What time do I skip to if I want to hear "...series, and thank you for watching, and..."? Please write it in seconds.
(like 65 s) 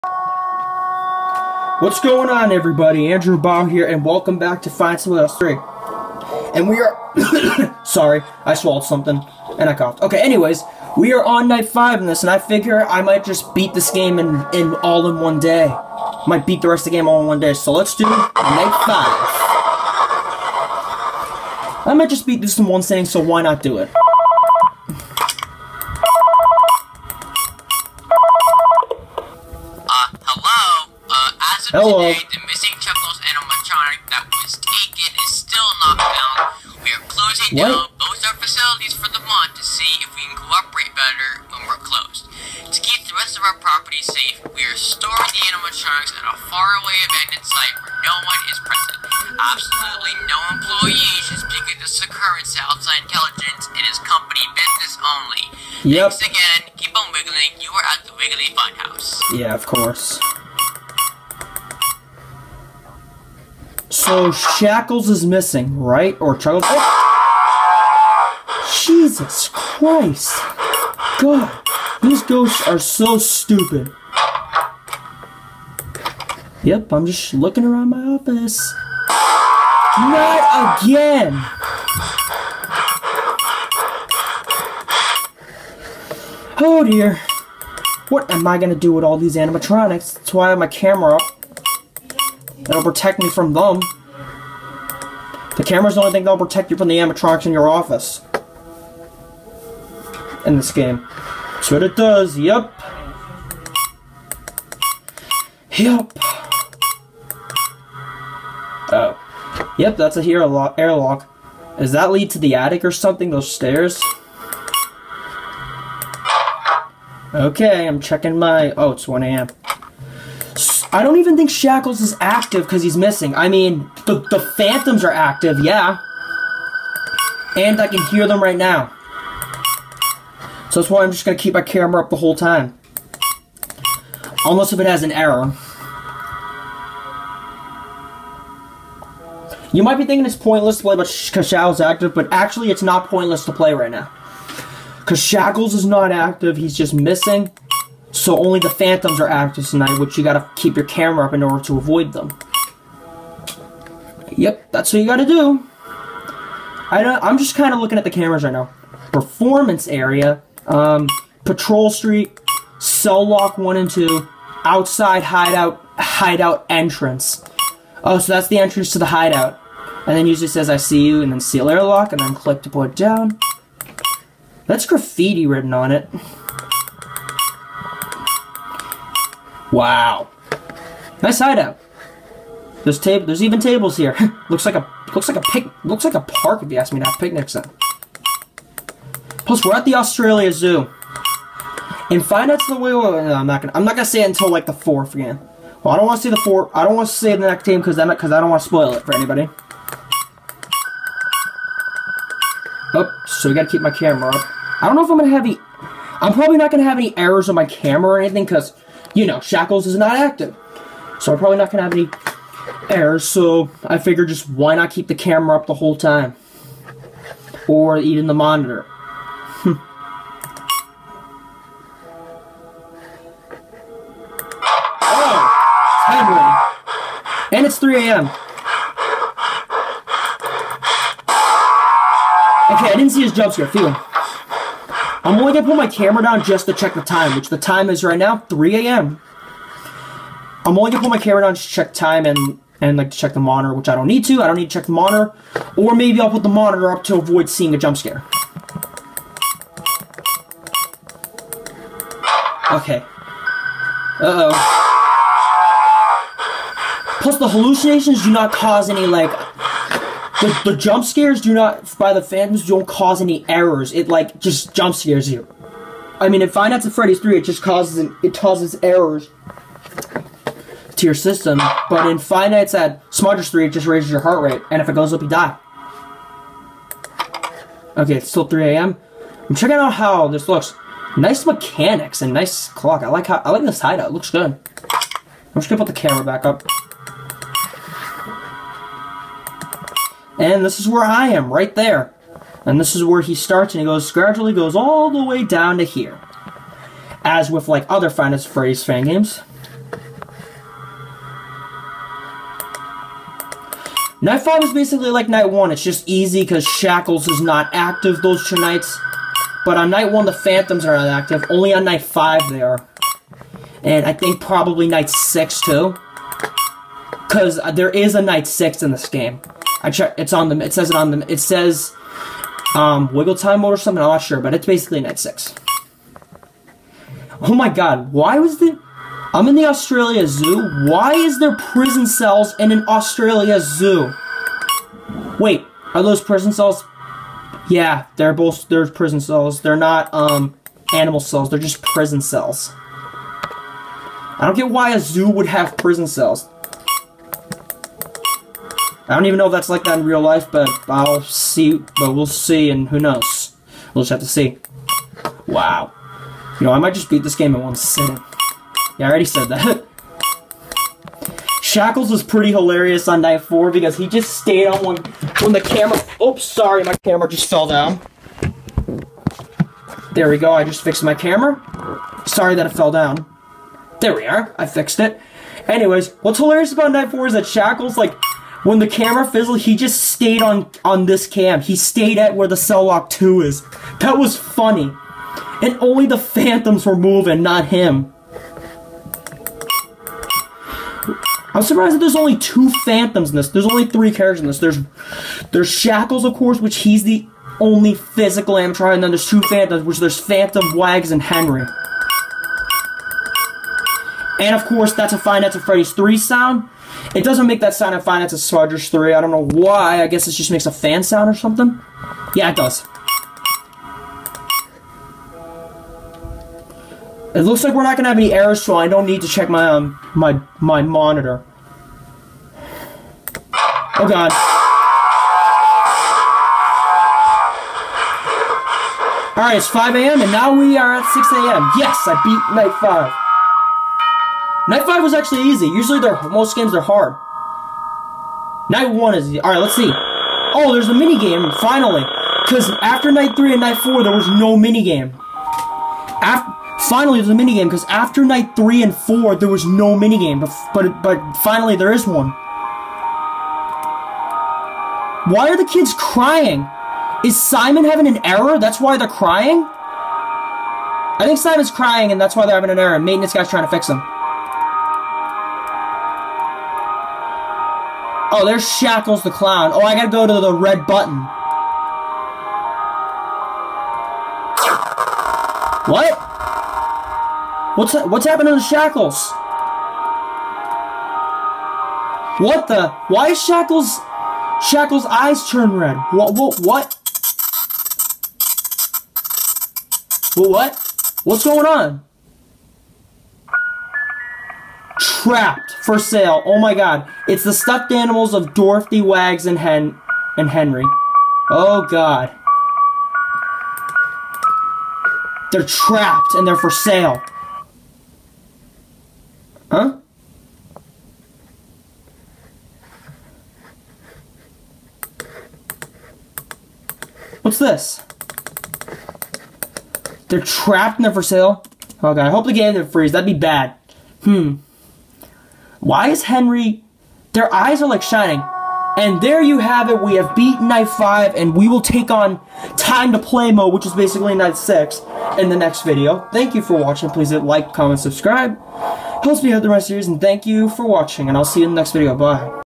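540 s.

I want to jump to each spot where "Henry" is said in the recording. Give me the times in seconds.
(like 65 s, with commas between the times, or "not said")
401 s, 500 s, 526 s.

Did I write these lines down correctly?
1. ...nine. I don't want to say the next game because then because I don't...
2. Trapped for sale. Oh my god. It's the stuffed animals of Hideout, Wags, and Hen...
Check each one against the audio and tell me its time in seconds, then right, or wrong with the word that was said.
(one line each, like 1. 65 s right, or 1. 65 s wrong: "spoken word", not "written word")
1. 196 s wrong: "four", not "nine"
2. 495 s wrong: "Dorothy", not "Hideout".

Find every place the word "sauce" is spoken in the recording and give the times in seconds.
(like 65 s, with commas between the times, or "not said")
not said.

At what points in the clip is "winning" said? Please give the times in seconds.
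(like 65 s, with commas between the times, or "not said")
not said.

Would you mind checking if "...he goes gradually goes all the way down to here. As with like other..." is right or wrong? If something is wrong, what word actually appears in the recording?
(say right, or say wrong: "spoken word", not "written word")
right.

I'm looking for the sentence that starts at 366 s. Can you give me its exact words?
Oops, sorry, my camera just fell down.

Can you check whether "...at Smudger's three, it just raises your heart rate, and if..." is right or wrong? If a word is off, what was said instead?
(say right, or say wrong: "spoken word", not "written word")
right.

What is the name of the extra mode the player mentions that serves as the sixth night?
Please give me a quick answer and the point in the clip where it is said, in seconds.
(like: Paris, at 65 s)
Wiggle time mode, at 323 s.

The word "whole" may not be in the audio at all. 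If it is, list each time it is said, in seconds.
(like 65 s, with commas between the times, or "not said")
132 s, 215 s.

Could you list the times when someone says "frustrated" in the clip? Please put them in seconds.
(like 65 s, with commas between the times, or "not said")
not said.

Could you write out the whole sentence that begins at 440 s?
Oh, there's a mini game finally.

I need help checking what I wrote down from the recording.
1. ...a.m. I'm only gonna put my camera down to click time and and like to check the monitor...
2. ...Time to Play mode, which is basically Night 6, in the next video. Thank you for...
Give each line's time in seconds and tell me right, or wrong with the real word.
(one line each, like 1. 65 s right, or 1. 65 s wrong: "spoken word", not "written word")
1. 238 s wrong: "check", not "click"
2. 532 s right.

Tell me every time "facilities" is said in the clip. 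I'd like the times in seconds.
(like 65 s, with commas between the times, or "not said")
38 s.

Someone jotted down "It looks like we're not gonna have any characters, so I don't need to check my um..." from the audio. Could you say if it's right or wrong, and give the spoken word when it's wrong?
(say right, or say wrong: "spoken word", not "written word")
wrong: "errors", not "characters".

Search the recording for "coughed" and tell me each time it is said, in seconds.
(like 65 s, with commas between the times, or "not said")
9 s.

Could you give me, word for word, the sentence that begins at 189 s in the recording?
Plus, we're at the Australia Zoo.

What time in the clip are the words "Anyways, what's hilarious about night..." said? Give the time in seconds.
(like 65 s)
375 s.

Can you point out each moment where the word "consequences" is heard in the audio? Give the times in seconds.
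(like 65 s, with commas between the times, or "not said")
not said.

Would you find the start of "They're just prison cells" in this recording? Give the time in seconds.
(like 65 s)
341 s.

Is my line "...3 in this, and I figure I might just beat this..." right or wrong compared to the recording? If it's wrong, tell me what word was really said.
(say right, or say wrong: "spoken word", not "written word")
wrong: "5", not "3".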